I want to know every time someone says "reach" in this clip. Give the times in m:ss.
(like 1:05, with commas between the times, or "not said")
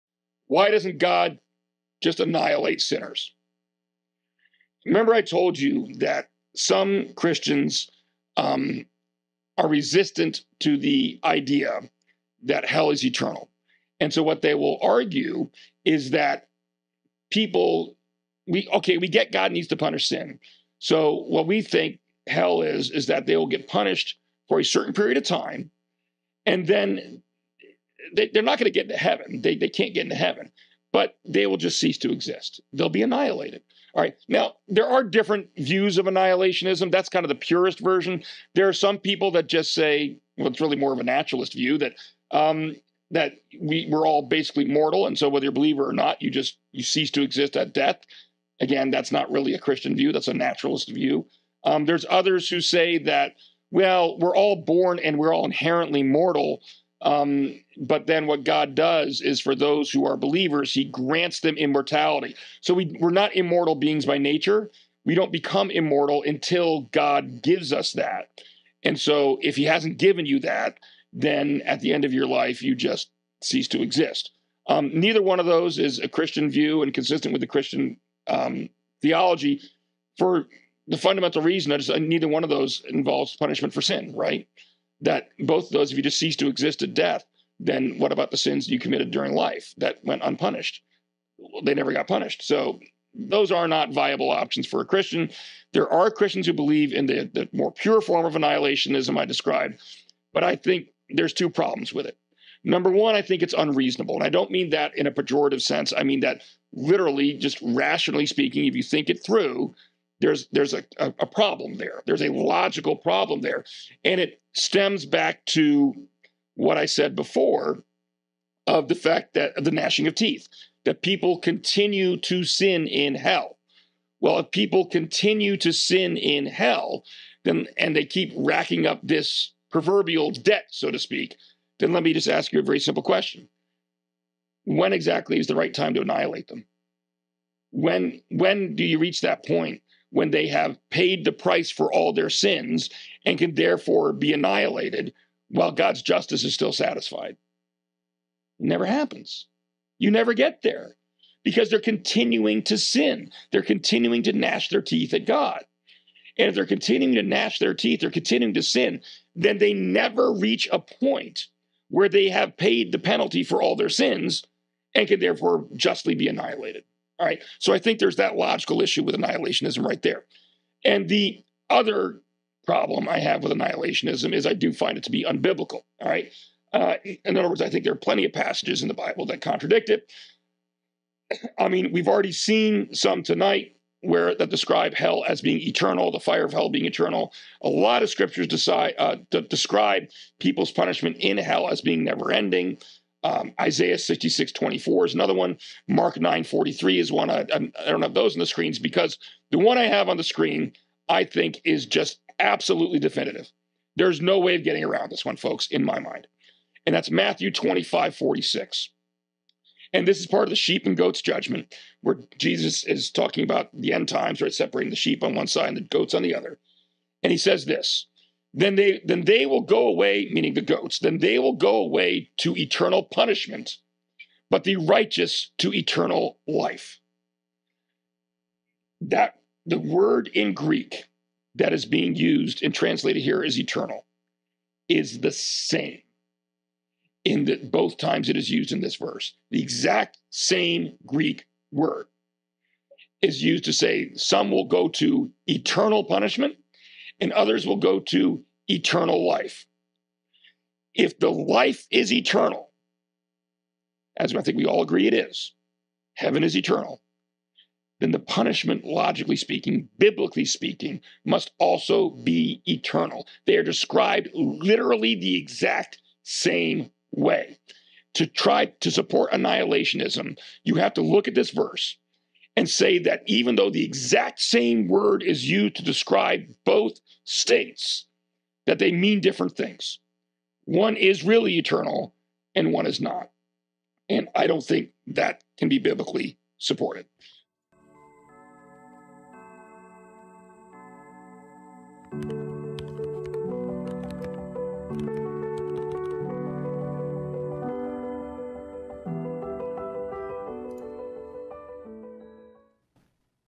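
2:18, 2:40.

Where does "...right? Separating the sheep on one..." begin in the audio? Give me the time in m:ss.
3:34.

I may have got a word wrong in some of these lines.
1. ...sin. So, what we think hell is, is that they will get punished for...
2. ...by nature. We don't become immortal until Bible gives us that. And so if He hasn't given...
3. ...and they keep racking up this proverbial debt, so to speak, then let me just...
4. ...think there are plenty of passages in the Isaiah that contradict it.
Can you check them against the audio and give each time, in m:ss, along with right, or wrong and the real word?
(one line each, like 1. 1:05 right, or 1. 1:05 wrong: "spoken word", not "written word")
1. 0:20 right
2. 1:04 wrong: "God", not "Bible"
3. 2:07 right
4. 2:57 wrong: "Bible", not "Isaiah".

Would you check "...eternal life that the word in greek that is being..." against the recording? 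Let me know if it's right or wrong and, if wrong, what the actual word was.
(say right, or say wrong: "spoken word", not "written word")
right.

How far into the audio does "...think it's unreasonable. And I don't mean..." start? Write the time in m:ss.
1:43.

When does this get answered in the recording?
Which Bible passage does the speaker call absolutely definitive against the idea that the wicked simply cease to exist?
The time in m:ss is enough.
3:27.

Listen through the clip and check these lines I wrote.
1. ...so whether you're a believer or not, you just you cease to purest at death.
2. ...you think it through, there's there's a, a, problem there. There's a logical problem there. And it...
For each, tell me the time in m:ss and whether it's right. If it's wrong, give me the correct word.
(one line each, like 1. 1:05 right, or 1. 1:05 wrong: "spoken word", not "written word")
1. 0:45 wrong: "exist", not "purest"
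2. 1:48 right.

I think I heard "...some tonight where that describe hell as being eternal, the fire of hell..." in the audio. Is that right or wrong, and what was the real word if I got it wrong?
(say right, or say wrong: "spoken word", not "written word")
right.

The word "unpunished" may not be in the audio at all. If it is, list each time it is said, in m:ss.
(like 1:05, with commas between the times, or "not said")
1:30.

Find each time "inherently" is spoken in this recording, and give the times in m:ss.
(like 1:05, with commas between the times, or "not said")
0:55.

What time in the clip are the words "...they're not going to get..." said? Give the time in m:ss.
0:28.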